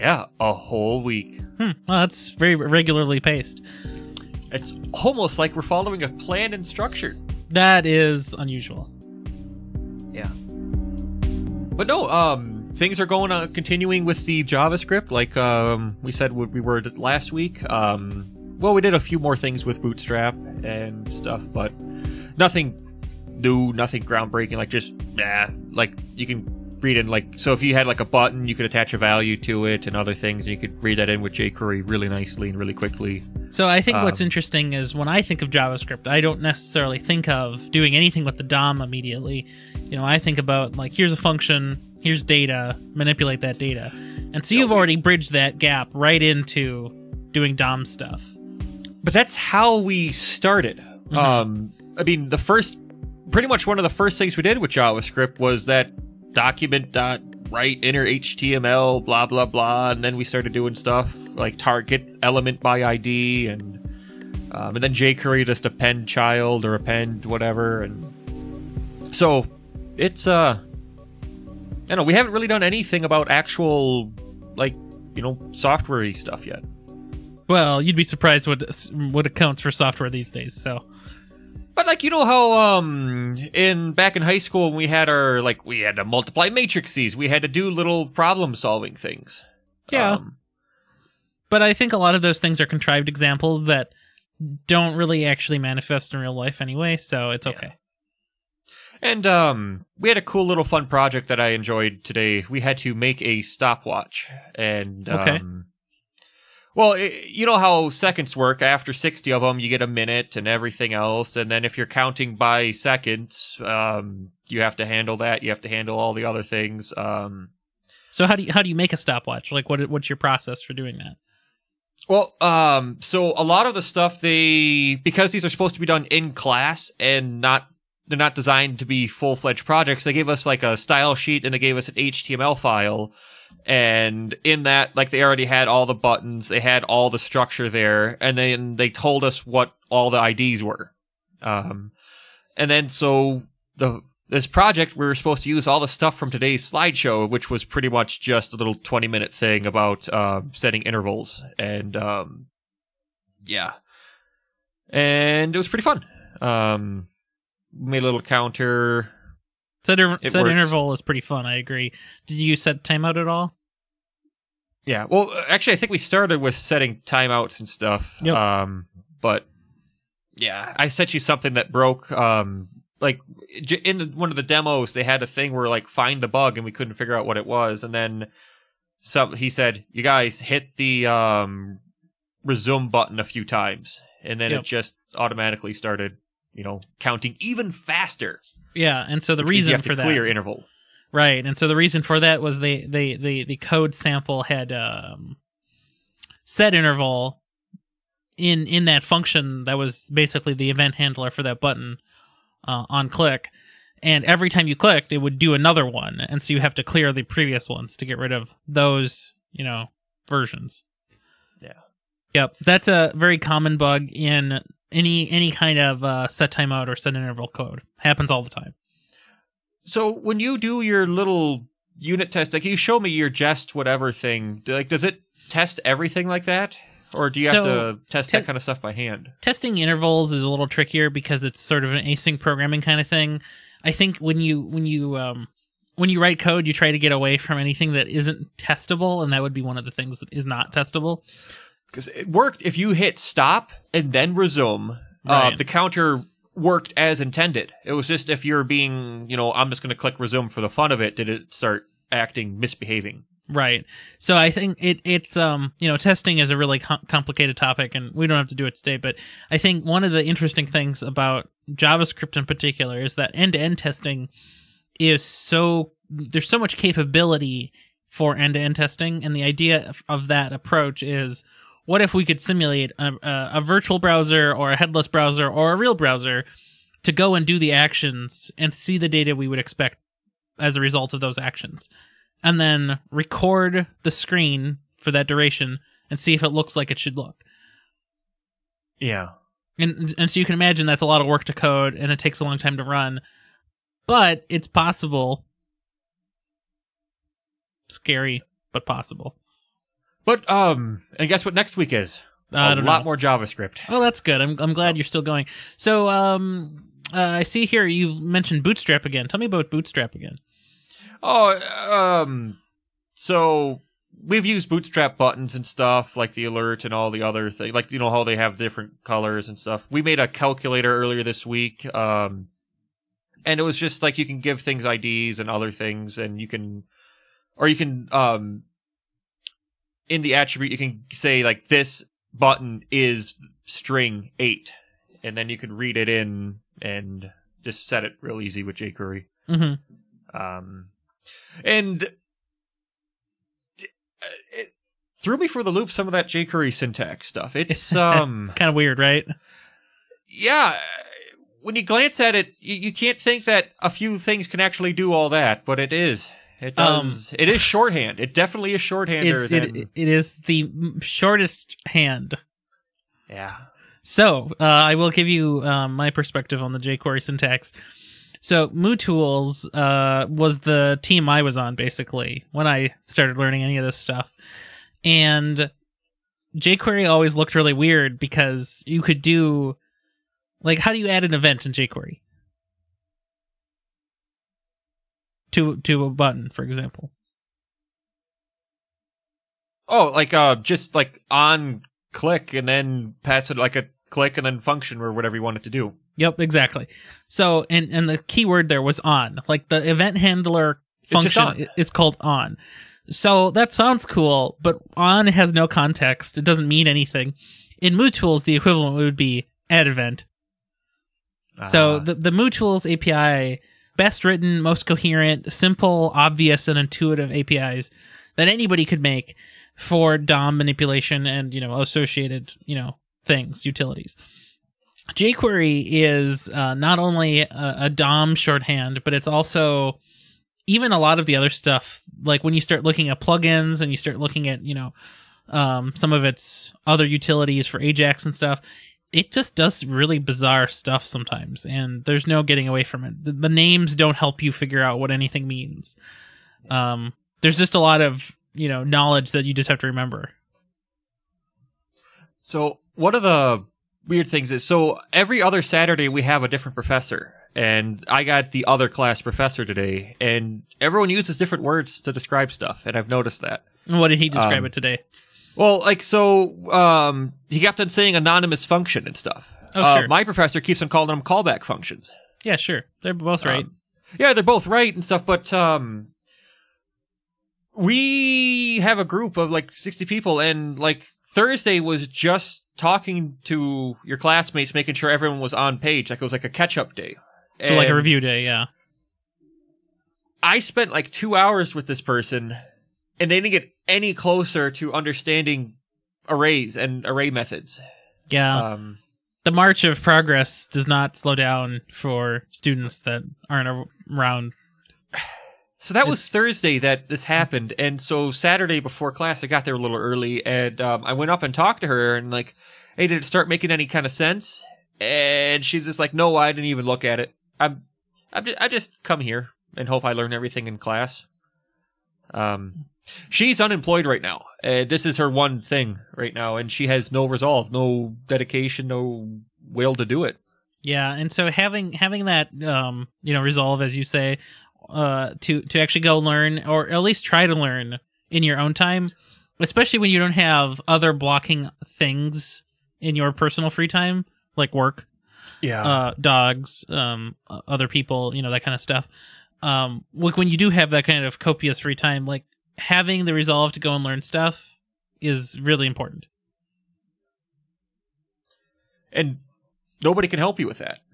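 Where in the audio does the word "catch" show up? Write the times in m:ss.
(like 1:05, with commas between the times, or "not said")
8:06.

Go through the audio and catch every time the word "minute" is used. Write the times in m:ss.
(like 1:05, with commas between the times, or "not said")
1:49, 2:29.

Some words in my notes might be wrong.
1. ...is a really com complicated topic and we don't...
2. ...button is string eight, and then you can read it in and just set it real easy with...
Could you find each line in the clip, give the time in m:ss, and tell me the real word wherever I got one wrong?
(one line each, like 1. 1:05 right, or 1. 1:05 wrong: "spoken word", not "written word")
1. 4:16 right
2. 5:32 right.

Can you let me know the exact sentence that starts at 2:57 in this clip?
And then some he said, "You guys hit the um, resume button a few times," and then yep.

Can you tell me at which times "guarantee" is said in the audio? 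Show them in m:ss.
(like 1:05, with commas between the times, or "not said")
not said.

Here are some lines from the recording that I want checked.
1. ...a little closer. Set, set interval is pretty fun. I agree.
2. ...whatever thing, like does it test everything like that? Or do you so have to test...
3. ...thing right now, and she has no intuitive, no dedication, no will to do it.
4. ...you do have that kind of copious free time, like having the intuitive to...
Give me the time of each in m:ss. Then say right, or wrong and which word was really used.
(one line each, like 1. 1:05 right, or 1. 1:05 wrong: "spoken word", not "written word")
1. 2:38 wrong: "counter", not "closer"
2. 3:43 right
3. 8:45 wrong: "resolve", not "intuitive"
4. 9:10 wrong: "resolve", not "intuitive".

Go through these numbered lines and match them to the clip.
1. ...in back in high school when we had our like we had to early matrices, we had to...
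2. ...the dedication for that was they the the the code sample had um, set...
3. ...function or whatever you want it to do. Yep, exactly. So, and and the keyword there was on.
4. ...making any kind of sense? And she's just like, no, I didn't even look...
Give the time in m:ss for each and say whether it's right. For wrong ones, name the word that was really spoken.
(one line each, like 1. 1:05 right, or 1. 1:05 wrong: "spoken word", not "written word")
1. 1:23 wrong: "multiply", not "early"
2. 3:11 wrong: "reason", not "dedication"
3. 6:34 right
4. 8:33 right.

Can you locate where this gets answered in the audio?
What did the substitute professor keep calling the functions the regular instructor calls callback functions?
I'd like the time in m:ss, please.
7:48.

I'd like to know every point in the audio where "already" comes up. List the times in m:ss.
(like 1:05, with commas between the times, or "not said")
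0:44, 2:15.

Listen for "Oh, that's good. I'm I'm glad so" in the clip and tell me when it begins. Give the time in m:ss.
5:03.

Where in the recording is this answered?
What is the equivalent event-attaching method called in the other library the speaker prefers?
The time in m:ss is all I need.
6:49.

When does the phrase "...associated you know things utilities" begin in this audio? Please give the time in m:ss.
7:01.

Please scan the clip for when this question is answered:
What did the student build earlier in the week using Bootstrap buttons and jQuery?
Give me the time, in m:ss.
5:20.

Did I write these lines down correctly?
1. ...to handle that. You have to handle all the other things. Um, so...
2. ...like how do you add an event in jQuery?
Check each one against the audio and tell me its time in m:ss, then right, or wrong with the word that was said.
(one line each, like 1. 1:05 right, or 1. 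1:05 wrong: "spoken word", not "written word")
1. 1:54 right
2. 6:20 right.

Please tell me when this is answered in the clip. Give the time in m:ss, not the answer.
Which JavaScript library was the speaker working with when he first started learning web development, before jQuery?
6:08.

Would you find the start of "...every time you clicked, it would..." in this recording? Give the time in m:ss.
3:24.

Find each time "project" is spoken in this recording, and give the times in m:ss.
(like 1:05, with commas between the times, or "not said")
1:40, 2:09, 2:24.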